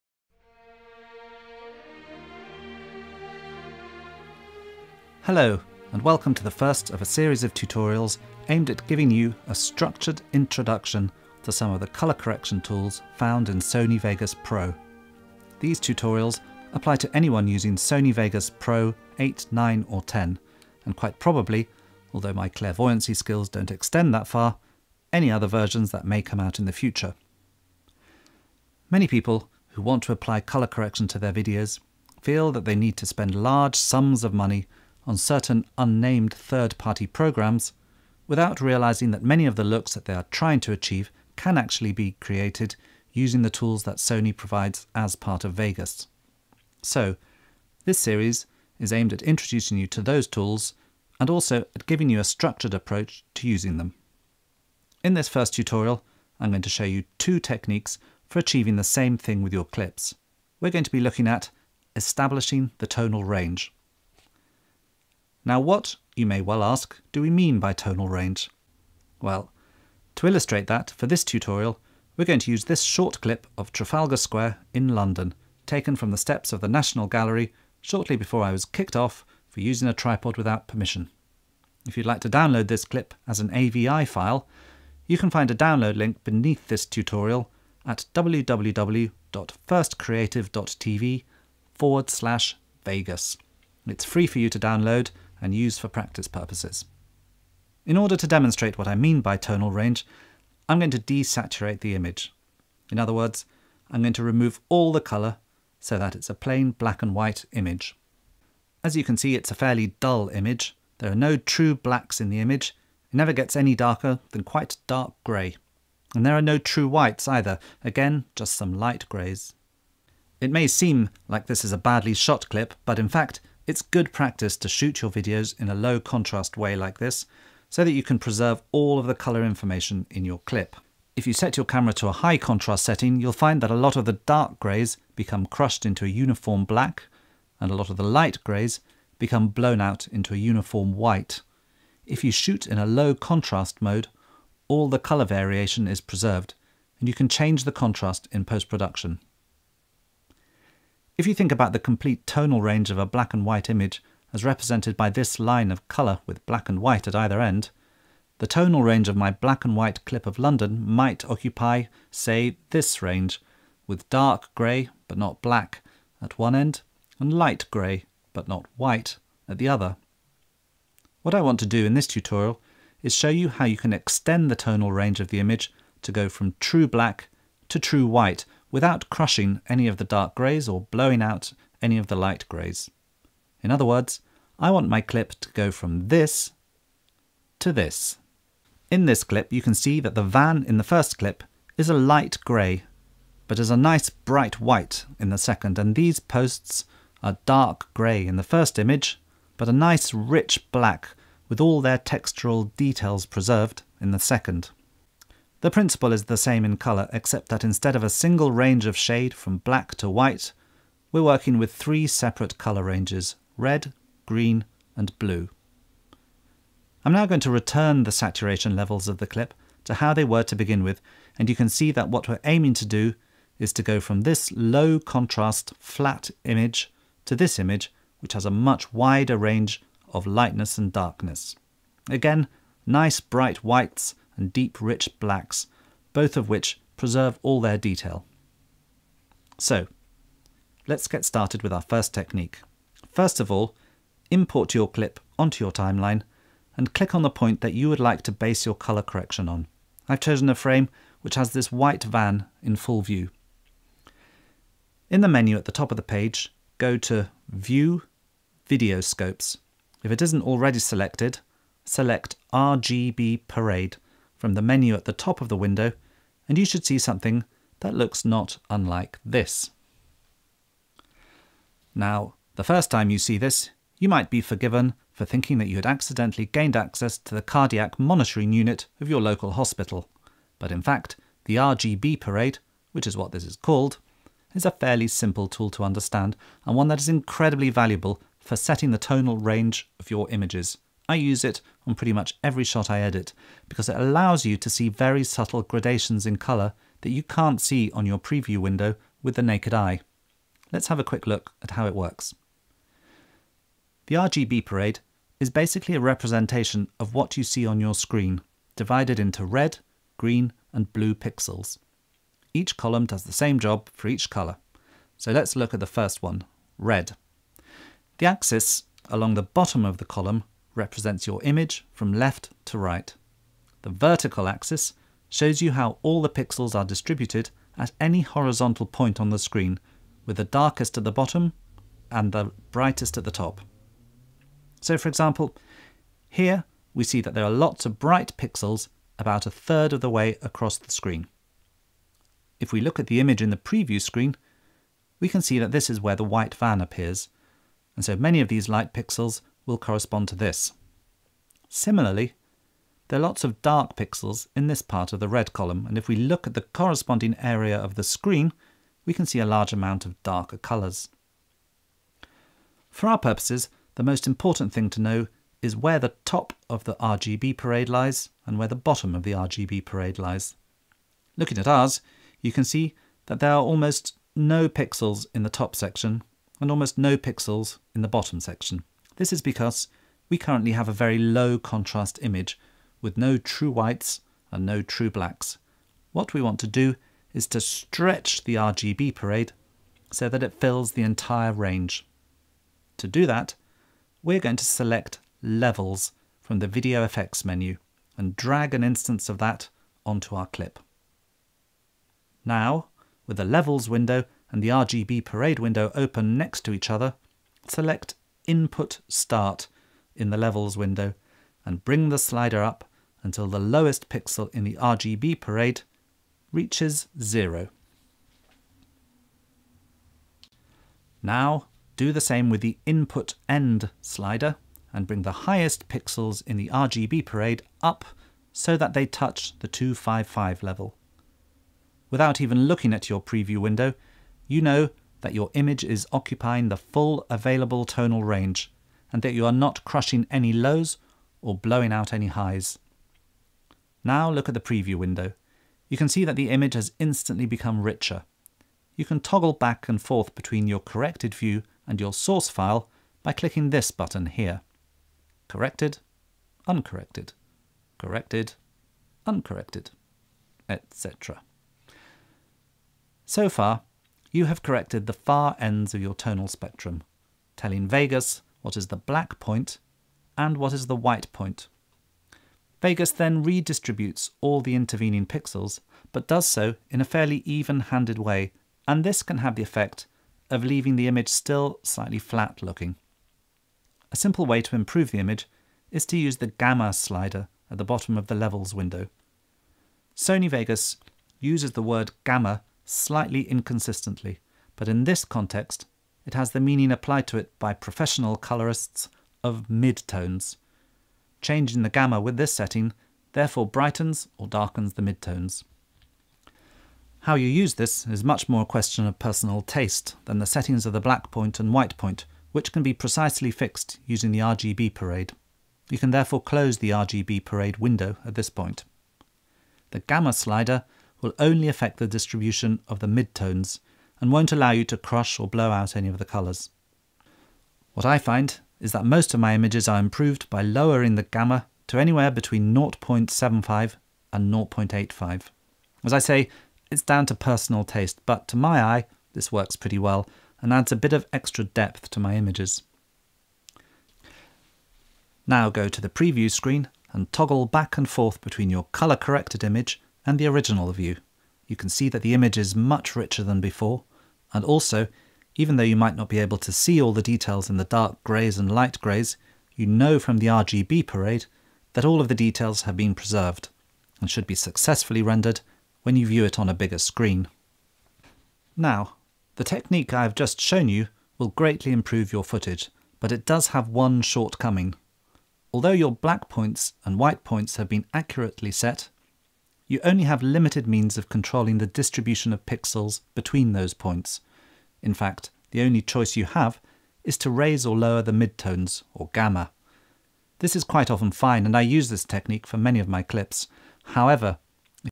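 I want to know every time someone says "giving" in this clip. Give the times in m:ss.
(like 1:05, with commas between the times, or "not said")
0:08, 0:51.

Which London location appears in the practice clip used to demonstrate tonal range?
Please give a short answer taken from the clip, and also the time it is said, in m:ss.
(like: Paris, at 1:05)
Trafalgar Square, at 1:13.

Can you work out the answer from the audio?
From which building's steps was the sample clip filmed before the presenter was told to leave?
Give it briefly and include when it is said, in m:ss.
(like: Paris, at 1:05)
National Gallery, at 1:16.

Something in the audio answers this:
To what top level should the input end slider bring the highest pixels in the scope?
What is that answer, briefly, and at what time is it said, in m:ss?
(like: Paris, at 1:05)
255, at 7:09.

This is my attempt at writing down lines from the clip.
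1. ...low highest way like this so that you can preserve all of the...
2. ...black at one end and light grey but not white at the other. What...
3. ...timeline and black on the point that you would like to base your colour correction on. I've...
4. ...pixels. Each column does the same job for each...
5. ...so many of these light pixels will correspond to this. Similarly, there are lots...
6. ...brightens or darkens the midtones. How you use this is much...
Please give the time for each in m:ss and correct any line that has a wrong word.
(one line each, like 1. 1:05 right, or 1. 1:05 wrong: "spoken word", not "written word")
1. 2:05 wrong: "contrast", not "highest"
2. 2:45 right
3. 4:05 wrong: "click", not "black"
4. 5:11 right
5. 5:48 right
6. 8:23 right.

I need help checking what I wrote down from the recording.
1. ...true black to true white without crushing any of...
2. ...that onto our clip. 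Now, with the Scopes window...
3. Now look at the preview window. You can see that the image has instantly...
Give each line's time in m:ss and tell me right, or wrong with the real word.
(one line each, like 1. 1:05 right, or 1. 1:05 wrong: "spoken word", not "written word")
1. 2:56 right
2. 6:39 wrong: "Levels", not "Scopes"
3. 7:24 right.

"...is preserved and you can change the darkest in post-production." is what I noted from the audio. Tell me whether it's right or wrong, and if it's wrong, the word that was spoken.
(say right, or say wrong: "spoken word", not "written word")
wrong: "contrast", not "darkest".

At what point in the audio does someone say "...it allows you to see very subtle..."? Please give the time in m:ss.
4:53.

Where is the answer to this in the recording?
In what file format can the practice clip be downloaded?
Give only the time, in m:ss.
1:23.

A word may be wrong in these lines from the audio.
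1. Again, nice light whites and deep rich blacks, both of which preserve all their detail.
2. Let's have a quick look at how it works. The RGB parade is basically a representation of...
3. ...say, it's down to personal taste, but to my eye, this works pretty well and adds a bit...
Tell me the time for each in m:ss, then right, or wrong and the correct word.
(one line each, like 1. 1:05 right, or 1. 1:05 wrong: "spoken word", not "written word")
1. 3:52 wrong: "bright", not "light"
2. 5:00 right
3. 8:56 right.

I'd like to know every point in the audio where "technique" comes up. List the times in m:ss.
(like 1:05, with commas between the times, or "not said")
0:57, 4:02, 9:29, 9:52.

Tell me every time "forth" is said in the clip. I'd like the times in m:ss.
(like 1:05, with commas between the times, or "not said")
7:30, 9:08.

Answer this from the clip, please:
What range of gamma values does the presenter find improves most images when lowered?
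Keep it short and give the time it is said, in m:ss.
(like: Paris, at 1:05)
0.75 to 0.85, at 8:52.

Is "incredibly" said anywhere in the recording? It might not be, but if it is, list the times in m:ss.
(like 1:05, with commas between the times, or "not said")
4:47.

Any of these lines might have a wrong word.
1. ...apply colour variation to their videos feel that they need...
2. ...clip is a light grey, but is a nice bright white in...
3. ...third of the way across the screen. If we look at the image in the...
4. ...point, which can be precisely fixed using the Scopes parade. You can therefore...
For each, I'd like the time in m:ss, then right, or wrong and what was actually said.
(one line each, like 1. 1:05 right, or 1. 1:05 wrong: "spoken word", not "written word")
1. 0:30 wrong: "correction", not "variation"
2. 3:11 right
3. 5:39 right
4. 8:31 wrong: "RGB", not "Scopes".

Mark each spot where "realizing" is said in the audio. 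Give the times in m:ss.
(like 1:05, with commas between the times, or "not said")
0:38.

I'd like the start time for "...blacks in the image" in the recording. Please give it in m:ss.
1:51.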